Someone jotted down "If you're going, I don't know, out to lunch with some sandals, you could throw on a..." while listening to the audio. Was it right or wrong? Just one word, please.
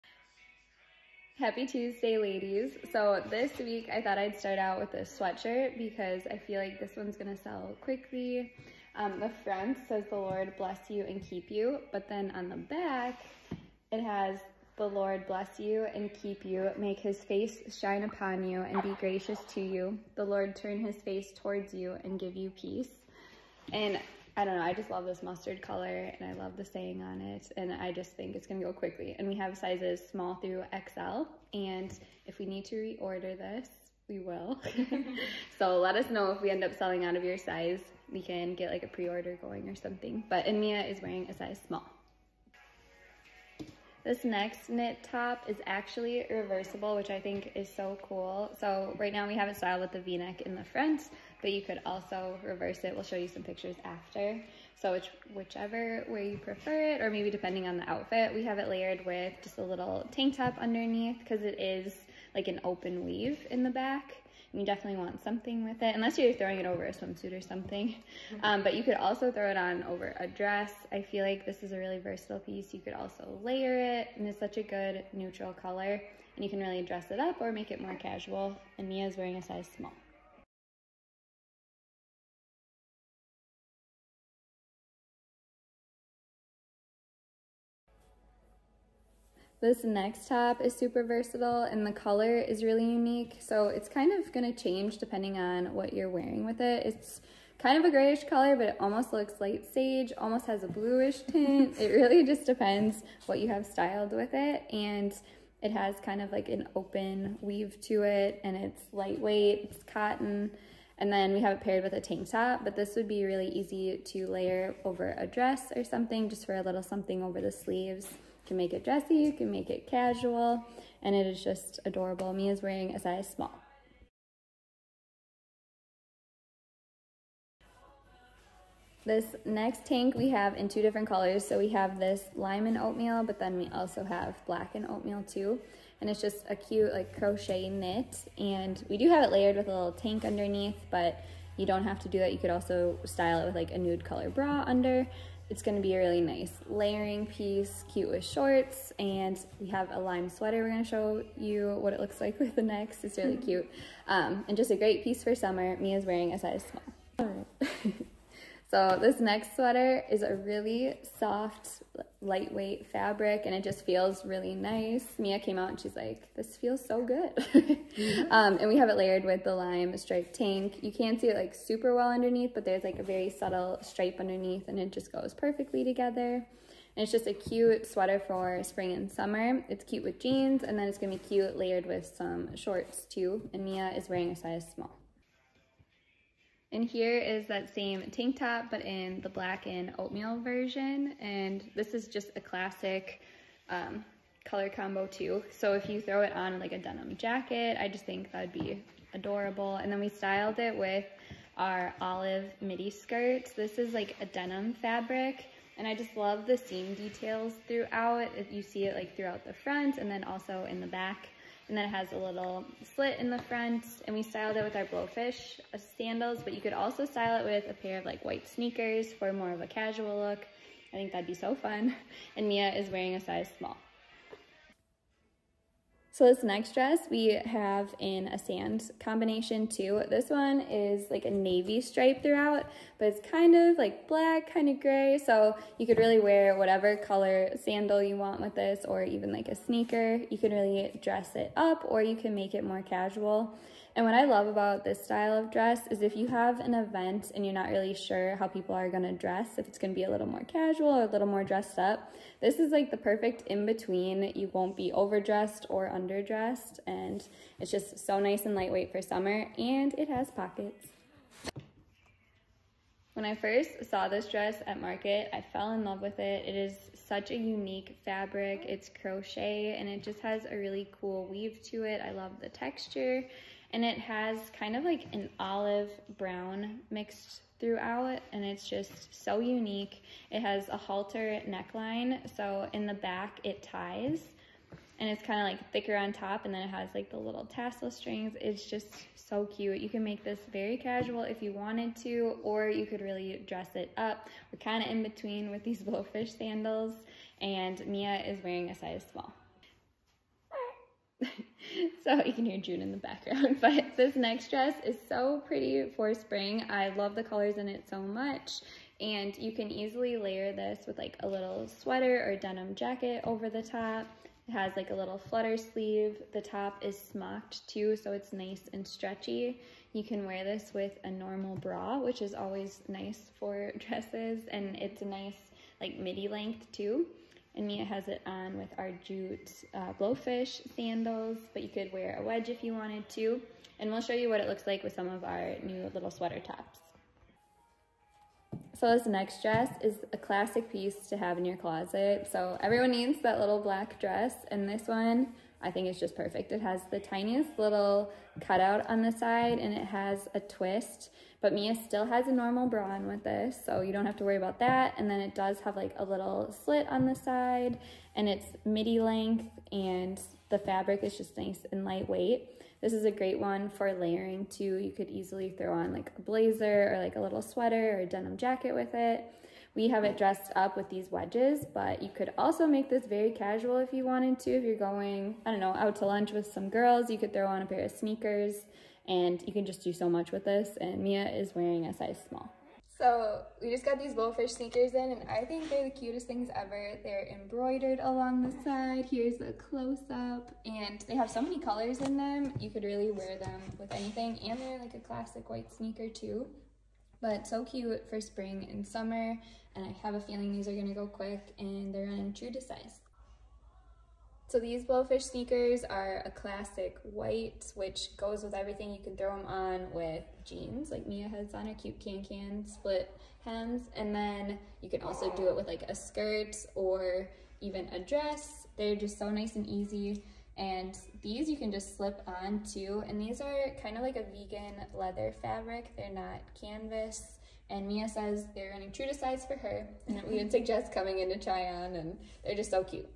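wrong.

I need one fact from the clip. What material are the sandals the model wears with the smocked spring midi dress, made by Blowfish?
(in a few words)
jute.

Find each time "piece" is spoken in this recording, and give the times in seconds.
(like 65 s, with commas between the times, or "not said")
72 s, 147 s, 155 s, 340 s.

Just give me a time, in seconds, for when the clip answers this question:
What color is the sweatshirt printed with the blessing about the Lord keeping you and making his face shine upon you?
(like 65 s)
25 s.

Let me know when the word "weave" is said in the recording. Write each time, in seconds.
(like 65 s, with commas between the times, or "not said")
63 s, 107 s, 271 s.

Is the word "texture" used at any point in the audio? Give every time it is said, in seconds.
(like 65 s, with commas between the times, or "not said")
272 s.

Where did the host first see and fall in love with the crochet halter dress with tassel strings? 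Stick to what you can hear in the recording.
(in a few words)
Market.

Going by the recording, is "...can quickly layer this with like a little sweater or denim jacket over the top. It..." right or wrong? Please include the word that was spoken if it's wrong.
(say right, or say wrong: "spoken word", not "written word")
wrong: "easily", not "quickly".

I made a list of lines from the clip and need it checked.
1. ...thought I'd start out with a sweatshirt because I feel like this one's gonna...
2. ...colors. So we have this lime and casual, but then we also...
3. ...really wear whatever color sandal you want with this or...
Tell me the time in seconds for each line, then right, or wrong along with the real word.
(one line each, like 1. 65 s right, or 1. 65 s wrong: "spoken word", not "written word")
1. 4 s right
2. 131 s wrong: "oatmeal", not "casual"
3. 235 s right.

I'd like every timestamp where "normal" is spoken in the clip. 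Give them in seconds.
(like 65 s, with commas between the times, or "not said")
321 s, 352 s.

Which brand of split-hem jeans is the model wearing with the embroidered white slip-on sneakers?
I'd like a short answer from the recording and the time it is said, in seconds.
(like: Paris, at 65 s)
KanCan, at 411 s.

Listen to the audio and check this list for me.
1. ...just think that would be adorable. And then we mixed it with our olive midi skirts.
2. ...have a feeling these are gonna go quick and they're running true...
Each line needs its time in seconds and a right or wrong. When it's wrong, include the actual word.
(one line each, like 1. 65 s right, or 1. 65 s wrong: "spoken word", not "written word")
1. 197 s wrong: "styled", not "mixed"
2. 400 s right.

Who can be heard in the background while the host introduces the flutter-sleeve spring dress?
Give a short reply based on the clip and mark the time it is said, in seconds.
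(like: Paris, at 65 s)
June, at 302 s.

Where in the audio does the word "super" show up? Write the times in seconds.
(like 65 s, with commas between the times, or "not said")
90 s, 171 s.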